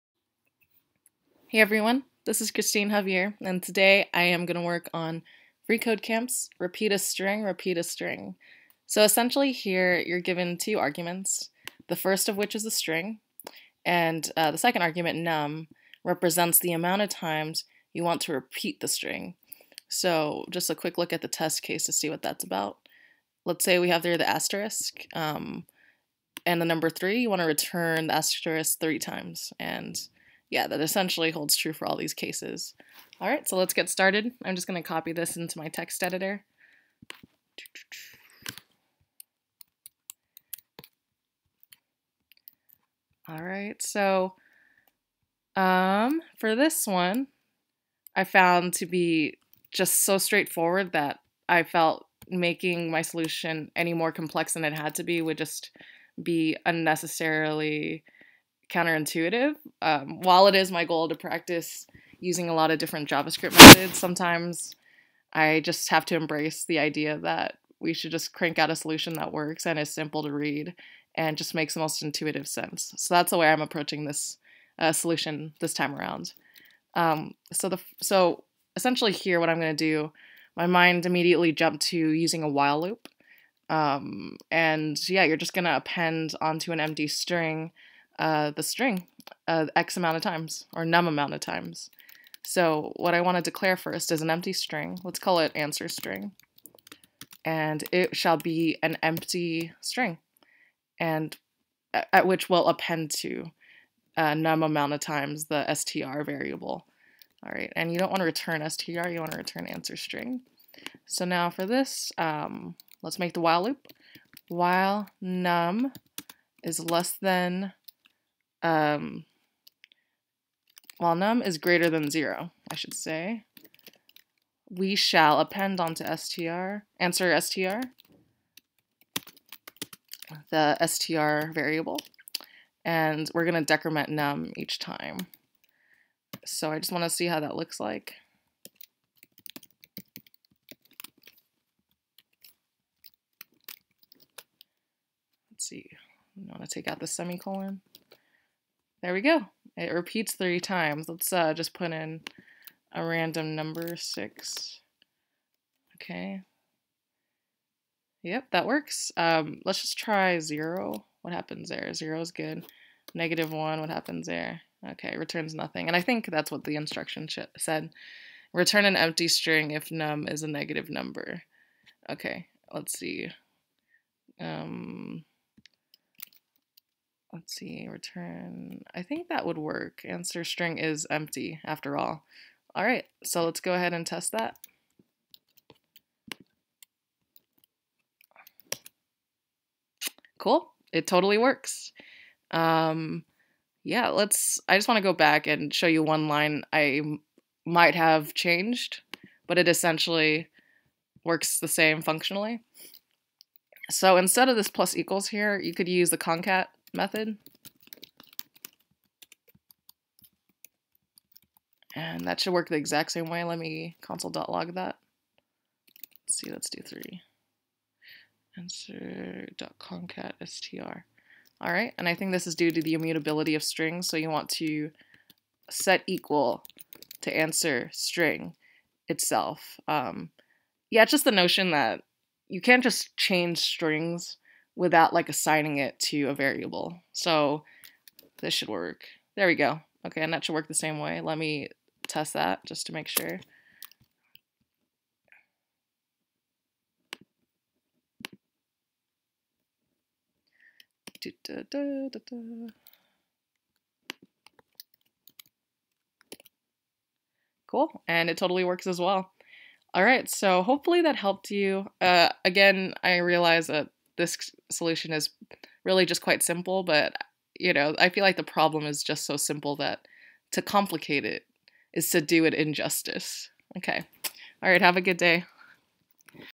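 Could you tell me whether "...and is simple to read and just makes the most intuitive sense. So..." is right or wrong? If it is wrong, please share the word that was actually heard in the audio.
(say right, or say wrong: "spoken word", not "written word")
right.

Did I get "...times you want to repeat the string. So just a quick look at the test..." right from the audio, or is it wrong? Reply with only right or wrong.
right.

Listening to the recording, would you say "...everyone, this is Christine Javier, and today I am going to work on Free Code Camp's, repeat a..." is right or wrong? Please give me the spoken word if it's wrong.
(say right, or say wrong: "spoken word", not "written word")
right.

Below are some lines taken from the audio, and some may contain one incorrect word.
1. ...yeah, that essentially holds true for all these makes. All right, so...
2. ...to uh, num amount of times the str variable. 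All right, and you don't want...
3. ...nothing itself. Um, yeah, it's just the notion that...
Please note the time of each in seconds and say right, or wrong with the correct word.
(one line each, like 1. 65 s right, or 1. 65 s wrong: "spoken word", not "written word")
1. 30 s wrong: "cases", not "makes"
2. 103 s right
3. 227 s wrong: "string", not "nothing".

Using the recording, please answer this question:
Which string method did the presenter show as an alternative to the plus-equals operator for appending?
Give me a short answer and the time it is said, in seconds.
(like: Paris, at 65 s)
concat, at 206 s.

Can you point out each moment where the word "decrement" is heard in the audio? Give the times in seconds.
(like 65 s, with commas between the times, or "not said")
133 s.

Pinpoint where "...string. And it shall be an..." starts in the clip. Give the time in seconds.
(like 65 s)
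95 s.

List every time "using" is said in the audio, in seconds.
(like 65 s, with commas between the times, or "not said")
62 s, 81 s.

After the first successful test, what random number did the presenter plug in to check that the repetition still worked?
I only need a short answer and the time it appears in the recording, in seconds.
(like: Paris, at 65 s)
6, at 153 s.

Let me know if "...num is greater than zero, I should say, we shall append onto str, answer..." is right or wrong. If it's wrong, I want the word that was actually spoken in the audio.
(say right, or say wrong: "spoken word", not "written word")
right.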